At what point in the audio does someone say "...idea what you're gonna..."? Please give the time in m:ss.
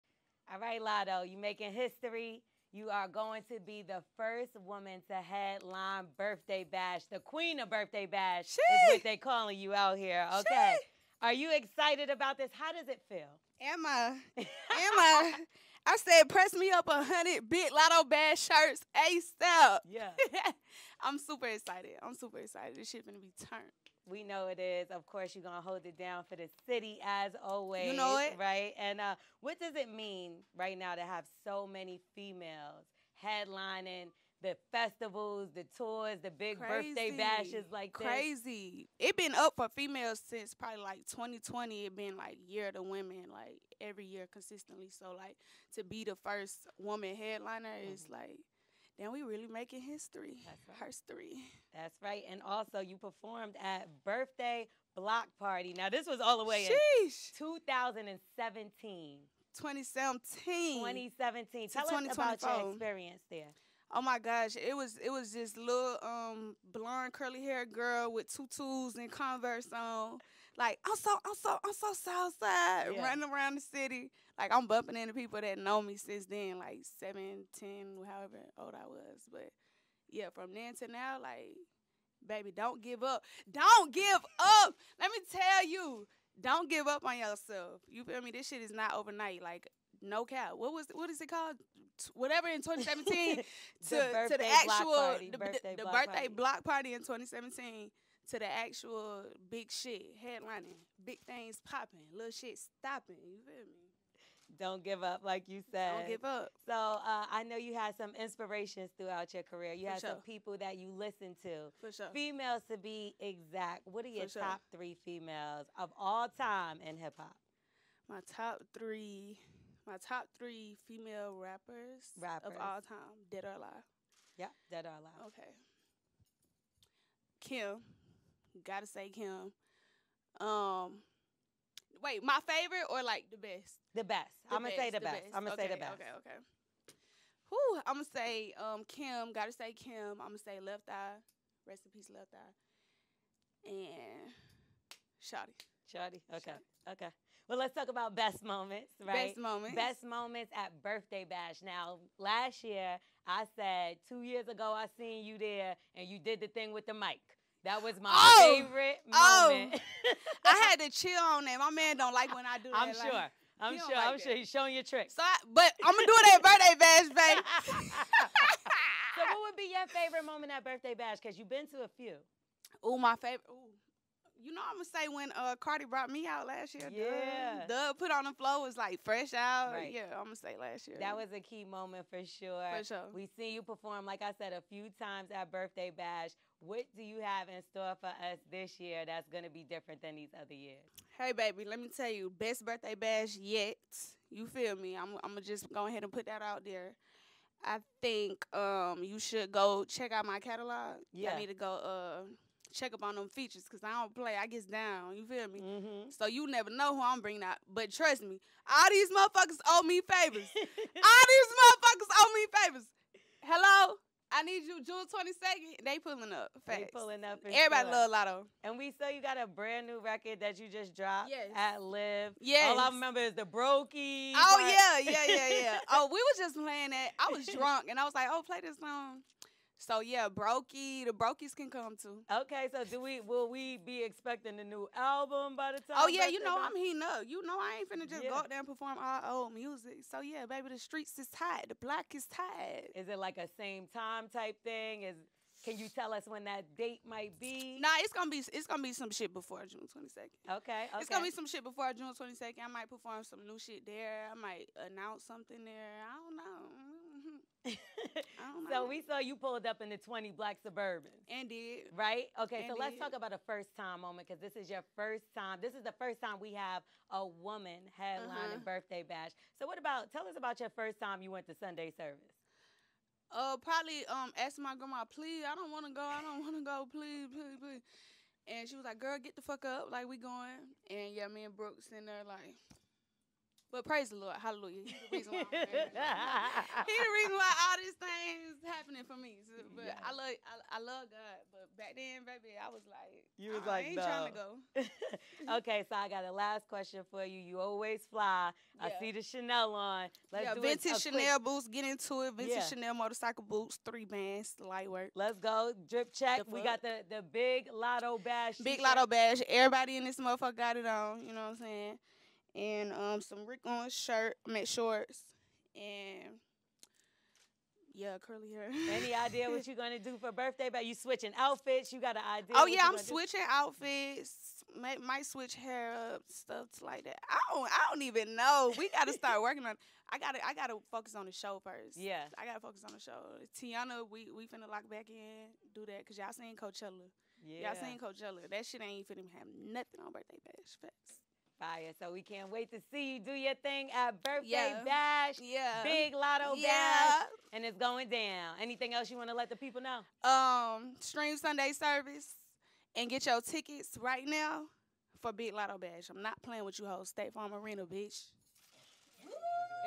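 5:19.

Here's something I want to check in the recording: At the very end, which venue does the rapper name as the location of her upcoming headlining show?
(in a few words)
State Farm Arena.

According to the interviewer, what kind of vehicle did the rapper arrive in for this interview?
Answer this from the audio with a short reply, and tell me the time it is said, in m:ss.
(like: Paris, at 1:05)
Black Suburban, at 4:20.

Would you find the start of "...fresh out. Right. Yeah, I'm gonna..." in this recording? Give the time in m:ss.
2:59.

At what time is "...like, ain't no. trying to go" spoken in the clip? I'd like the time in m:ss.
4:53.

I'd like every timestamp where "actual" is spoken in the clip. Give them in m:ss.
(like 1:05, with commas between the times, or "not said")
1:34, 1:38.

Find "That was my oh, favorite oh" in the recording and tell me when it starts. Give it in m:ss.
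2:37.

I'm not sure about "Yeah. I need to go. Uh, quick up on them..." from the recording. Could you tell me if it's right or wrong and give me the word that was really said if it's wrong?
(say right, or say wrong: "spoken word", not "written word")
wrong: "check", not "quick".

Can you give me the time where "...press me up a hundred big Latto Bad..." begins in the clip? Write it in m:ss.
0:16.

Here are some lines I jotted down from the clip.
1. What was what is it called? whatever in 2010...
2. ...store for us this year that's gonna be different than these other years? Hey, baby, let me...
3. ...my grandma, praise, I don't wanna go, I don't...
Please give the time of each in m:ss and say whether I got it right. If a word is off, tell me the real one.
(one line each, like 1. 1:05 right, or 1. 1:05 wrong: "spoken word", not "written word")
1. 1:30 wrong: "2017", not "2010"
2. 3:07 right
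3. 4:34 wrong: "please", not "praise".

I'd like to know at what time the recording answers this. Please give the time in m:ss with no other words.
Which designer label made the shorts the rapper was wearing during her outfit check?
5:13.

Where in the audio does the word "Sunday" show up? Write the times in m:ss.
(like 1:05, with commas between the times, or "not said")
4:31, 5:51.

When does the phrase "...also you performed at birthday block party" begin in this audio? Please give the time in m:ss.
0:52.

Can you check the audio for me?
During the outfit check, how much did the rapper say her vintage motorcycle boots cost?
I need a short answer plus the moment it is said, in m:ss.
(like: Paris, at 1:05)
3 bands, at 5:03.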